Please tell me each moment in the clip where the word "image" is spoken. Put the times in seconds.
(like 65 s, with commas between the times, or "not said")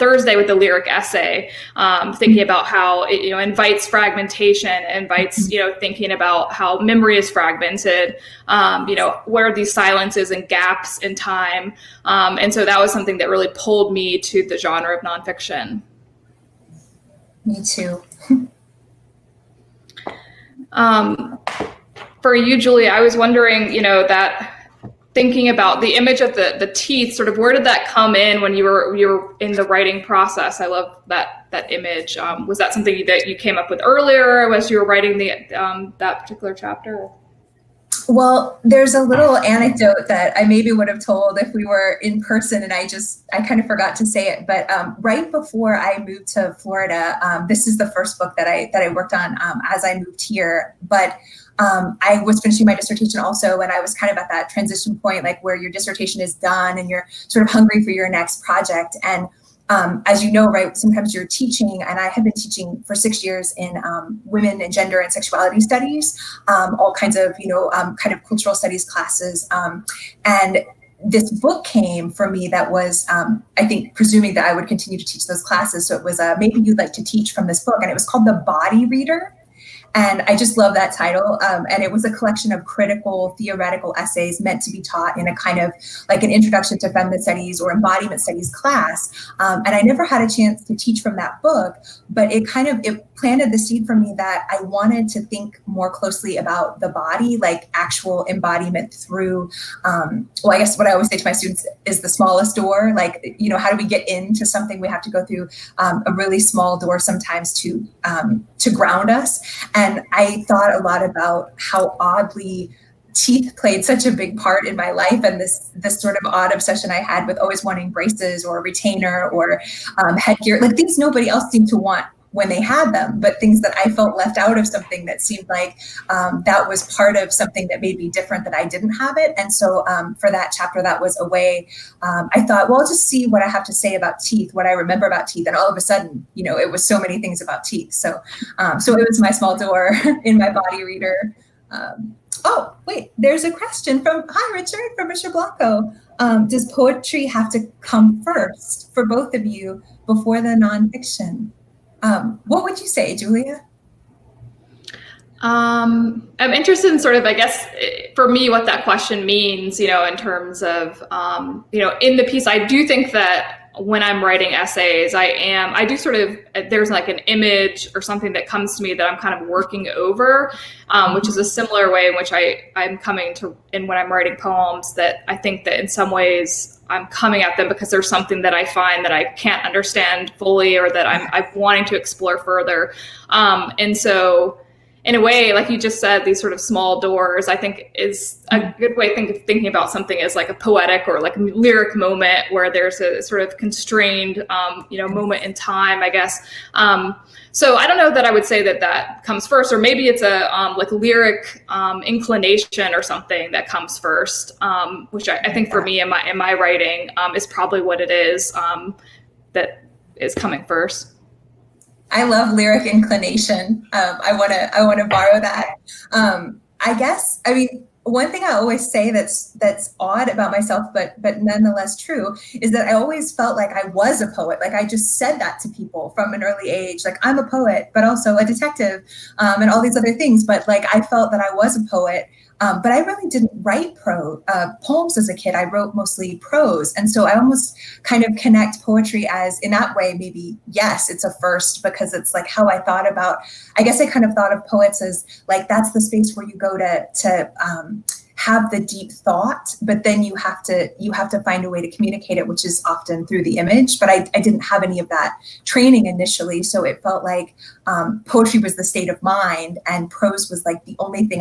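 25 s, 31 s, 167 s, 253 s.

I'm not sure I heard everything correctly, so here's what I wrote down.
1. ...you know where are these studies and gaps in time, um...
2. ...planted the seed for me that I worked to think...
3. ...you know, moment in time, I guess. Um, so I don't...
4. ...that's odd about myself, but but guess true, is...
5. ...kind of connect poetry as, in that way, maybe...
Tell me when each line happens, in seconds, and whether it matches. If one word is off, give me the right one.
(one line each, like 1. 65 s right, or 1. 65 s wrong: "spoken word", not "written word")
1. 8 s wrong: "silences", not "studies"
2. 93 s wrong: "wanted", not "worked"
3. 194 s right
4. 219 s wrong: "nonetheless", not "guess"
5. 238 s right.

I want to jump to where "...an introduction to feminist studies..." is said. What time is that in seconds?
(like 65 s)
86 s.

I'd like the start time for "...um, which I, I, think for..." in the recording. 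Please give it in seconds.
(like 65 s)
204 s.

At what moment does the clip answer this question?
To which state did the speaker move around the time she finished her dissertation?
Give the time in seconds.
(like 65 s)
46 s.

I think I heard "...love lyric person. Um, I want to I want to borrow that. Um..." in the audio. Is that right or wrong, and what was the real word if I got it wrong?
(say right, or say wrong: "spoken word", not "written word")
wrong: "inclination", not "person".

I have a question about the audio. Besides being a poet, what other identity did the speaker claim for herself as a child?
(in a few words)
detective.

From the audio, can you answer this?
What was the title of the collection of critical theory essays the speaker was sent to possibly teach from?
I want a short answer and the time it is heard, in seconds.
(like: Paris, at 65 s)
The Body Reader, at 78 s.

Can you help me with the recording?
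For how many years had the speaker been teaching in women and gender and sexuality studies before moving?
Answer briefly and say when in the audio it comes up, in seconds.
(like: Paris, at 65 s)
6, at 62 s.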